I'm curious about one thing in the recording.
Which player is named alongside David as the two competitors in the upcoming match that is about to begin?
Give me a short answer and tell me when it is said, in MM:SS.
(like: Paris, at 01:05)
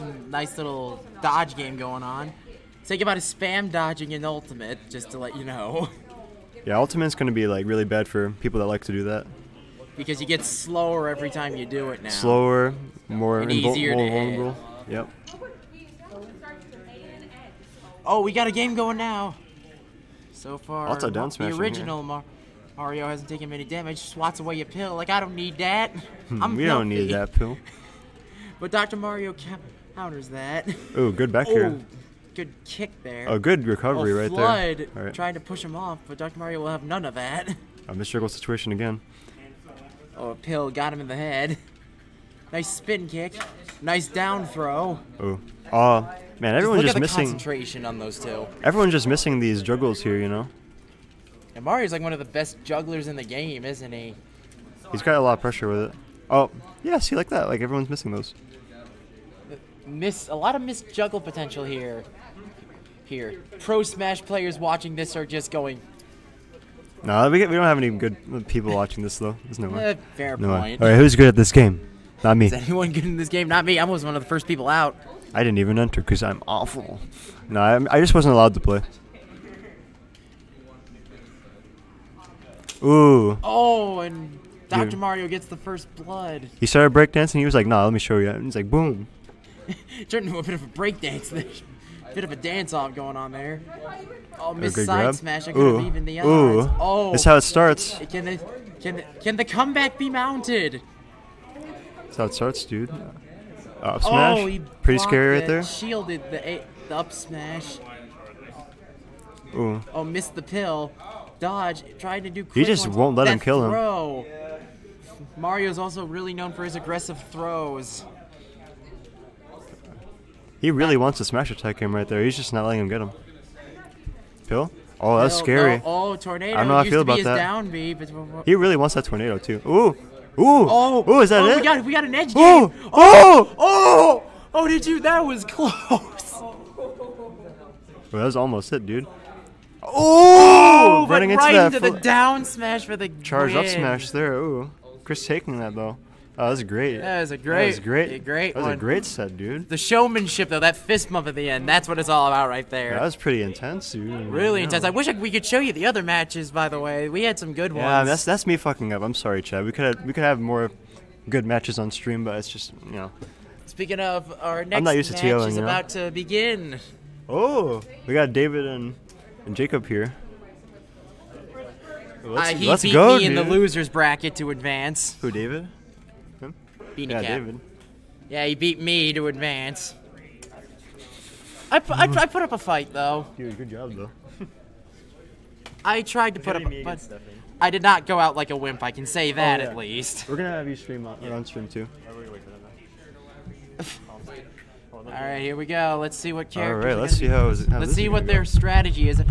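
Jacob, at 02:49.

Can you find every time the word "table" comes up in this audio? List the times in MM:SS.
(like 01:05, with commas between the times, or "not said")
not said.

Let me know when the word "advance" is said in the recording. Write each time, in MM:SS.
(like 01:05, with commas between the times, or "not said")
02:54, 02:59.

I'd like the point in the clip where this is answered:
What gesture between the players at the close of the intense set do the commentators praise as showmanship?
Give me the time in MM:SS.
02:30.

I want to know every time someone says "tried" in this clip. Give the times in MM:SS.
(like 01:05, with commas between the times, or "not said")
01:51, 03:06.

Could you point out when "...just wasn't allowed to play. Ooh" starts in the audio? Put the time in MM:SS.
01:18.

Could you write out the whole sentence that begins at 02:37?
Yeah, that's that's me fucking up.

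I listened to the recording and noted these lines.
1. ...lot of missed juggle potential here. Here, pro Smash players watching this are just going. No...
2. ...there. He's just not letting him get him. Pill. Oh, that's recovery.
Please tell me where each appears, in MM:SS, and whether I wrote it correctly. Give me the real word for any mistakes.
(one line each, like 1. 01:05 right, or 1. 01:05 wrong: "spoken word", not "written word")
1. 01:00 right
2. 02:02 wrong: "scary", not "recovery".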